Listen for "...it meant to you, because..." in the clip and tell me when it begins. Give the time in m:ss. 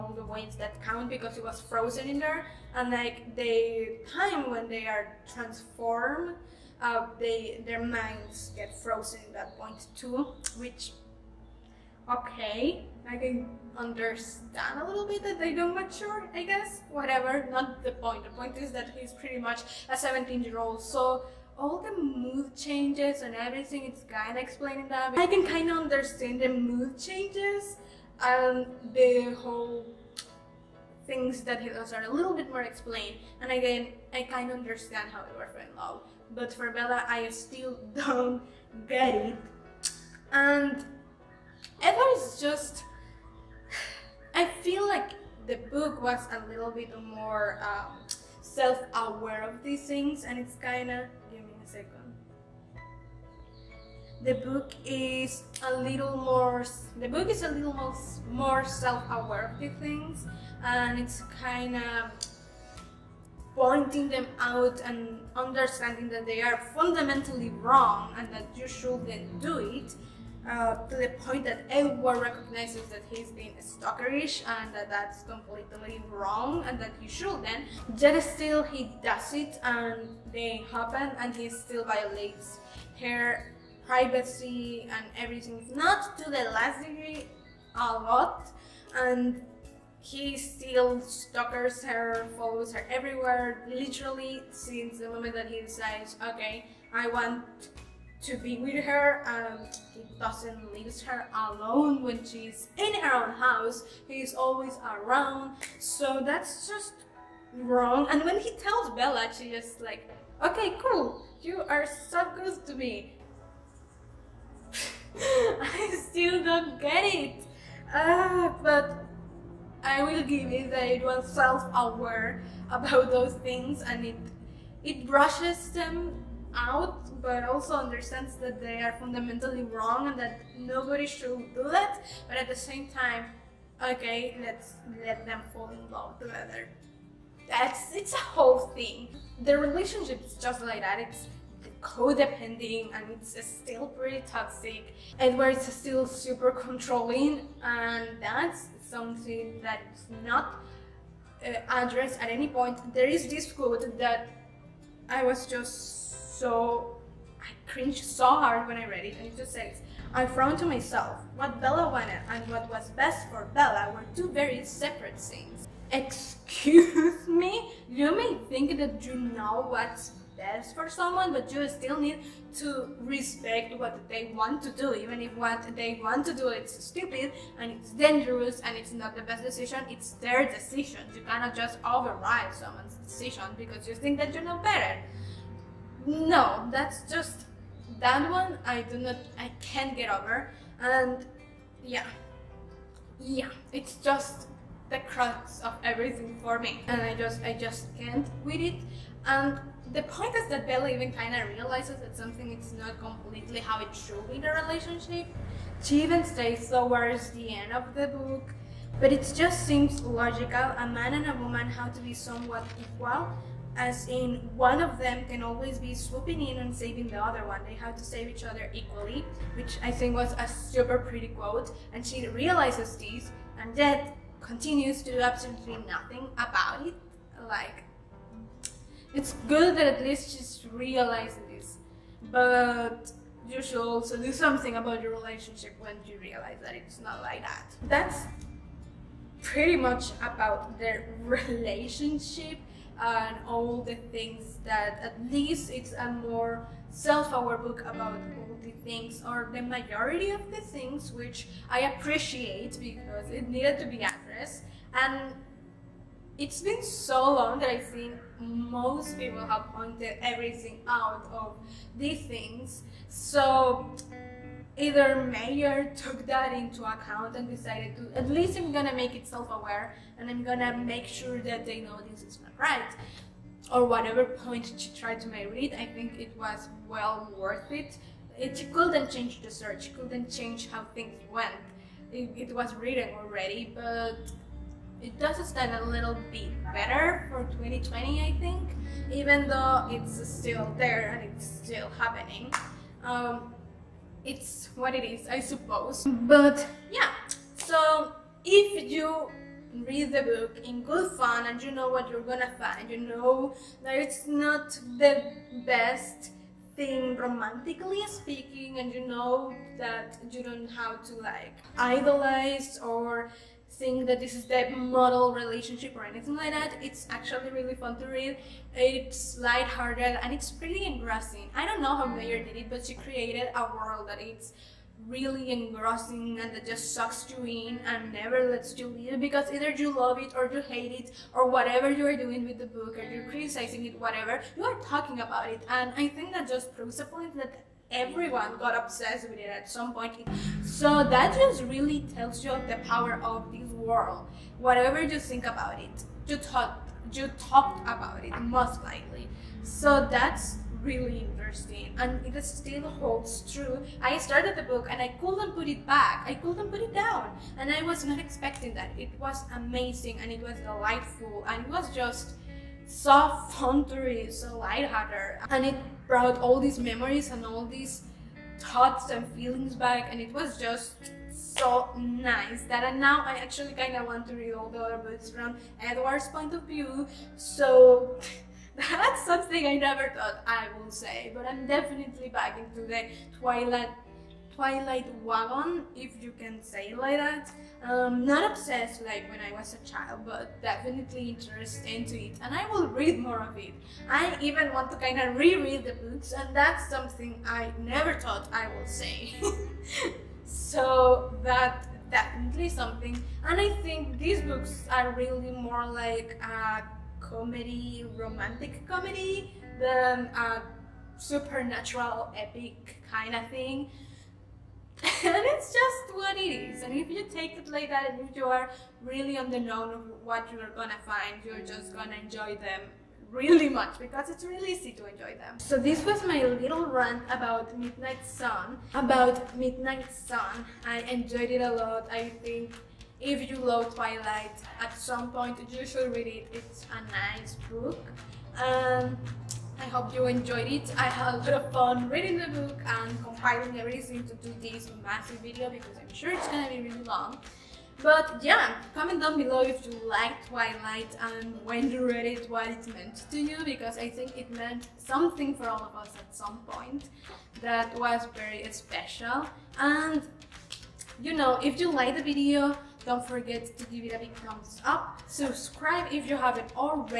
7:32.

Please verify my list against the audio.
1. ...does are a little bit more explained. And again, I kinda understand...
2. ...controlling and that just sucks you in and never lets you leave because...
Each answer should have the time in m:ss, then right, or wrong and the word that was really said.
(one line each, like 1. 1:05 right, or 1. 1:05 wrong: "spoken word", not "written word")
1. 0:31 right
2. 5:25 wrong: "engrossing", not "controlling".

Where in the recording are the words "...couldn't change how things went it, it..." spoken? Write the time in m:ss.
4:39.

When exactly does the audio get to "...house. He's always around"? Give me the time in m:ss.
1:43.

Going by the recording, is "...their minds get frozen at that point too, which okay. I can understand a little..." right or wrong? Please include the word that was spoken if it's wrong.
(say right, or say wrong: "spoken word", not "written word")
right.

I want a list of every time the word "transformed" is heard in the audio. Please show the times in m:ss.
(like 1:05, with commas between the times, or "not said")
0:05.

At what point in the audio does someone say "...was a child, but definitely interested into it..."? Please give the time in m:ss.
6:29.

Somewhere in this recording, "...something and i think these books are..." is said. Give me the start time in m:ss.
6:42.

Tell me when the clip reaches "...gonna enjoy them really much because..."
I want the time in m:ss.
7:01.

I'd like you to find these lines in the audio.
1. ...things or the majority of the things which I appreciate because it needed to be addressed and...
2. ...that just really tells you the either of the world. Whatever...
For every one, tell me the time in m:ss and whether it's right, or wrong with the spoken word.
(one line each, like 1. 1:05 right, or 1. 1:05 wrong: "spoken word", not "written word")
1. 4:08 right
2. 5:41 wrong: "power", not "either".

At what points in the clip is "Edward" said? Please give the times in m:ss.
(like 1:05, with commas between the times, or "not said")
0:41, 6:15.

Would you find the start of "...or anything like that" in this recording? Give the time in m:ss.
5:15.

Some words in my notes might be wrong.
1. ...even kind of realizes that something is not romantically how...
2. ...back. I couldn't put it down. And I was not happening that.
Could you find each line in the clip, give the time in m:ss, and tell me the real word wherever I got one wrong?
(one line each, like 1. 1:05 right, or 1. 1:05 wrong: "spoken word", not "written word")
1. 3:20 wrong: "completely", not "romantically"
2. 5:55 wrong: "expecting", not "happening".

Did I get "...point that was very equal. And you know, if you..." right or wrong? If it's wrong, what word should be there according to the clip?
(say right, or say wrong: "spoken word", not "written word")
wrong: "special", not "equal".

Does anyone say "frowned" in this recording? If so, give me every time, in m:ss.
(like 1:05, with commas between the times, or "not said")
2:40.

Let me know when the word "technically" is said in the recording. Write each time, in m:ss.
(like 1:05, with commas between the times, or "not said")
not said.